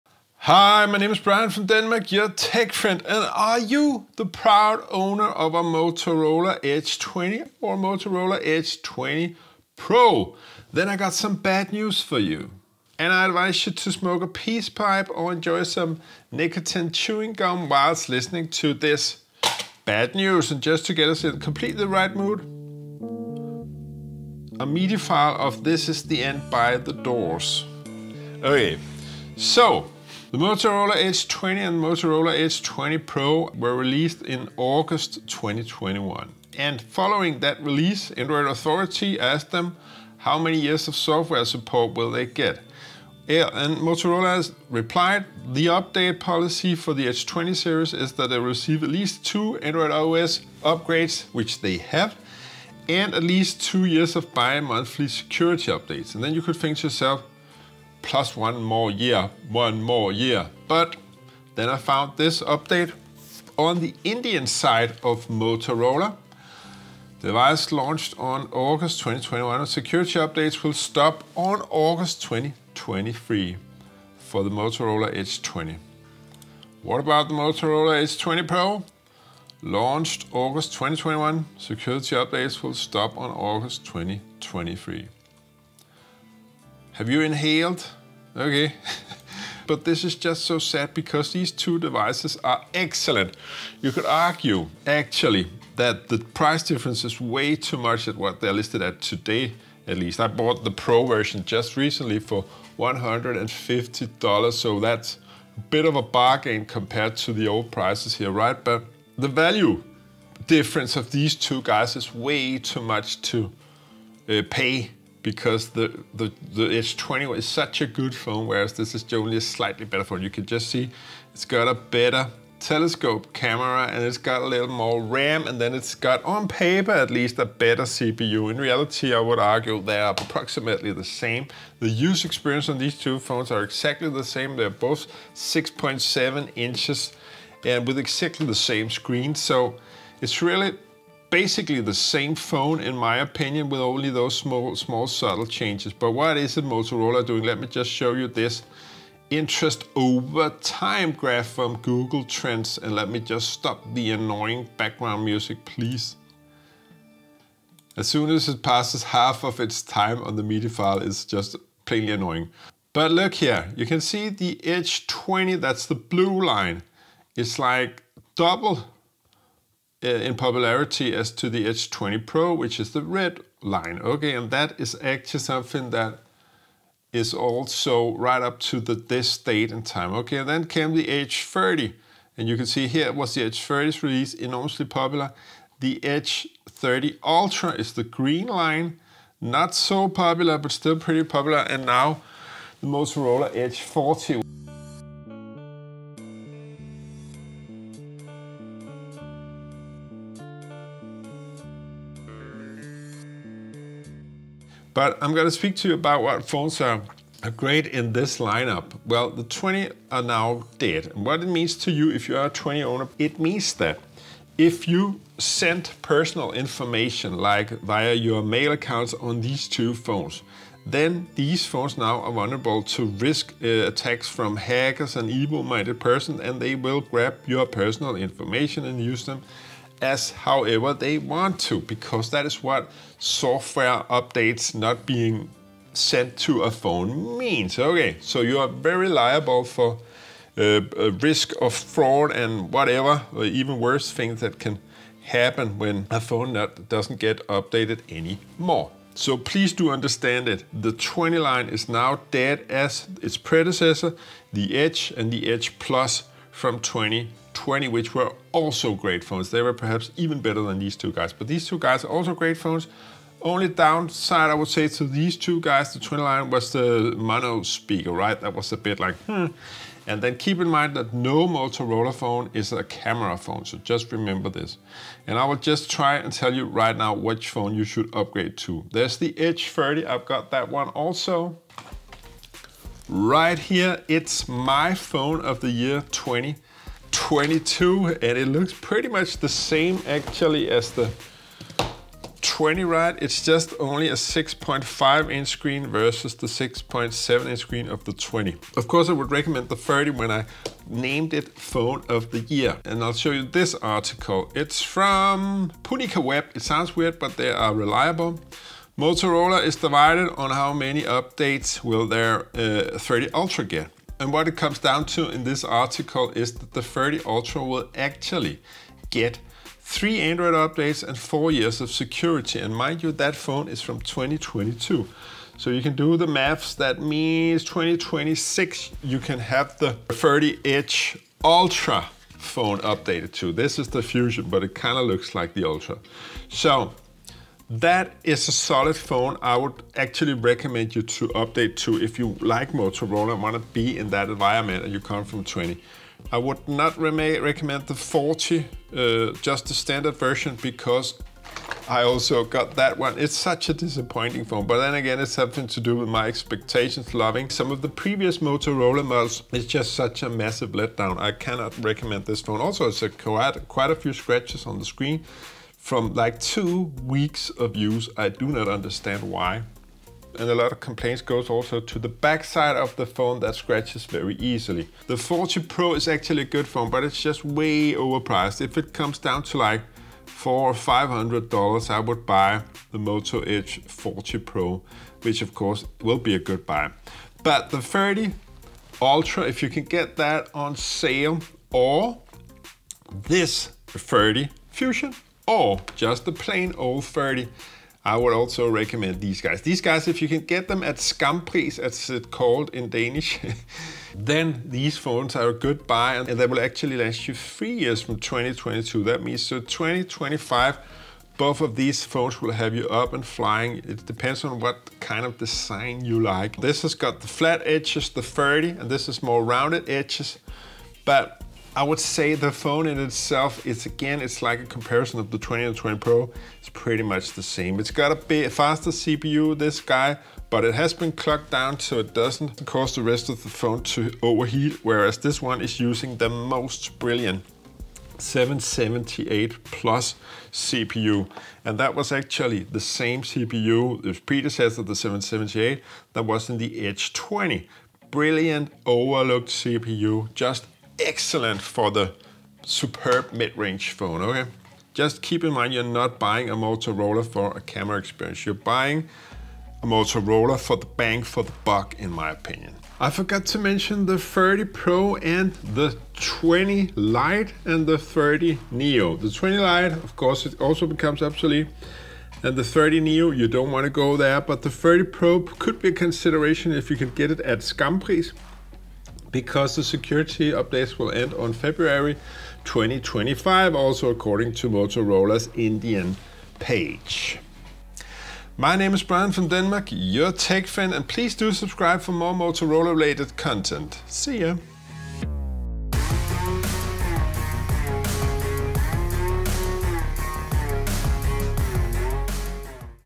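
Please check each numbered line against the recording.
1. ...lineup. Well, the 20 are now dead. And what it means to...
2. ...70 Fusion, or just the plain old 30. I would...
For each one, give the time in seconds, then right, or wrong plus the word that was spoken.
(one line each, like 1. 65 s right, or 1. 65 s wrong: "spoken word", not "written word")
1. 208 s right
2. 393 s wrong: "30", not "70".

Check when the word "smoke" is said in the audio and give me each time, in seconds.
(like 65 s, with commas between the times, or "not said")
13 s.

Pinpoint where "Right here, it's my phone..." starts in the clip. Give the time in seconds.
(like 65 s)
283 s.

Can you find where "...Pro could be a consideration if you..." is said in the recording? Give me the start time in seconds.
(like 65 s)
475 s.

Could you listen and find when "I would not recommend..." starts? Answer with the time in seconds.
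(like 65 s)
346 s.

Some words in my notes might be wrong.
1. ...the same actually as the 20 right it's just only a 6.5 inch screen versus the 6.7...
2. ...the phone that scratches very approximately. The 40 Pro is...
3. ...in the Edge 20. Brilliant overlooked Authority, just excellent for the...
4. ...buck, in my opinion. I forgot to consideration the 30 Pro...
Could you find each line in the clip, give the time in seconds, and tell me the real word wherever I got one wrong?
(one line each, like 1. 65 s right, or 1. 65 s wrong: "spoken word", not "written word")
1. 289 s right
2. 372 s wrong: "easily", not "approximately"
3. 446 s wrong: "CPU", not "Authority"
4. 461 s wrong: "mention", not "consideration".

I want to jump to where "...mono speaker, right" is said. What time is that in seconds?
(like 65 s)
267 s.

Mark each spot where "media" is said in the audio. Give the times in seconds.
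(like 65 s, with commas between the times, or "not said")
24 s, 160 s.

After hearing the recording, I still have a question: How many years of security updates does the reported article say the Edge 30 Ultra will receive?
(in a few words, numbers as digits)
4.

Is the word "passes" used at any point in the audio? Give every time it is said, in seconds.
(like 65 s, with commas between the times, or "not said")
158 s.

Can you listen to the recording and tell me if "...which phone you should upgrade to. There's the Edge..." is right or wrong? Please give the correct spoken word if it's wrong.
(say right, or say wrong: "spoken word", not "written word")
right.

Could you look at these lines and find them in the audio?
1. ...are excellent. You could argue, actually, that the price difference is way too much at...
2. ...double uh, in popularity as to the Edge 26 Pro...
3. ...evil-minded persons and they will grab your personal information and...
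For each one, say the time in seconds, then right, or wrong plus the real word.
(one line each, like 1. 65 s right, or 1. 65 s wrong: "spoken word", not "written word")
1. 92 s right
2. 168 s wrong: "20", not "26"
3. 225 s right.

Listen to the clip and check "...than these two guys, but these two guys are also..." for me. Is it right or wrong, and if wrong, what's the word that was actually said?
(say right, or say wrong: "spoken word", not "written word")
right.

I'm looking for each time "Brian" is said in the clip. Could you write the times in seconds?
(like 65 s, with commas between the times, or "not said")
1 s, 489 s.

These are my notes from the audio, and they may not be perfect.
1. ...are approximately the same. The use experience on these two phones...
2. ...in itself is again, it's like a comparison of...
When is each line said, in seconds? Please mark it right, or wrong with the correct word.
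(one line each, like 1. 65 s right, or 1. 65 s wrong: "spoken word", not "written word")
1. 129 s right
2. 422 s right.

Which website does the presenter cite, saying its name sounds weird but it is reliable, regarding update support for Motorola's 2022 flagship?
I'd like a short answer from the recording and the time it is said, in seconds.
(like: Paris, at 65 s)
PiunikaWeb, at 305 s.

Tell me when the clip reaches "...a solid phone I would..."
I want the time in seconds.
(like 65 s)
338 s.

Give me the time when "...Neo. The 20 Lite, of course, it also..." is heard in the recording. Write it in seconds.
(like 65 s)
468 s.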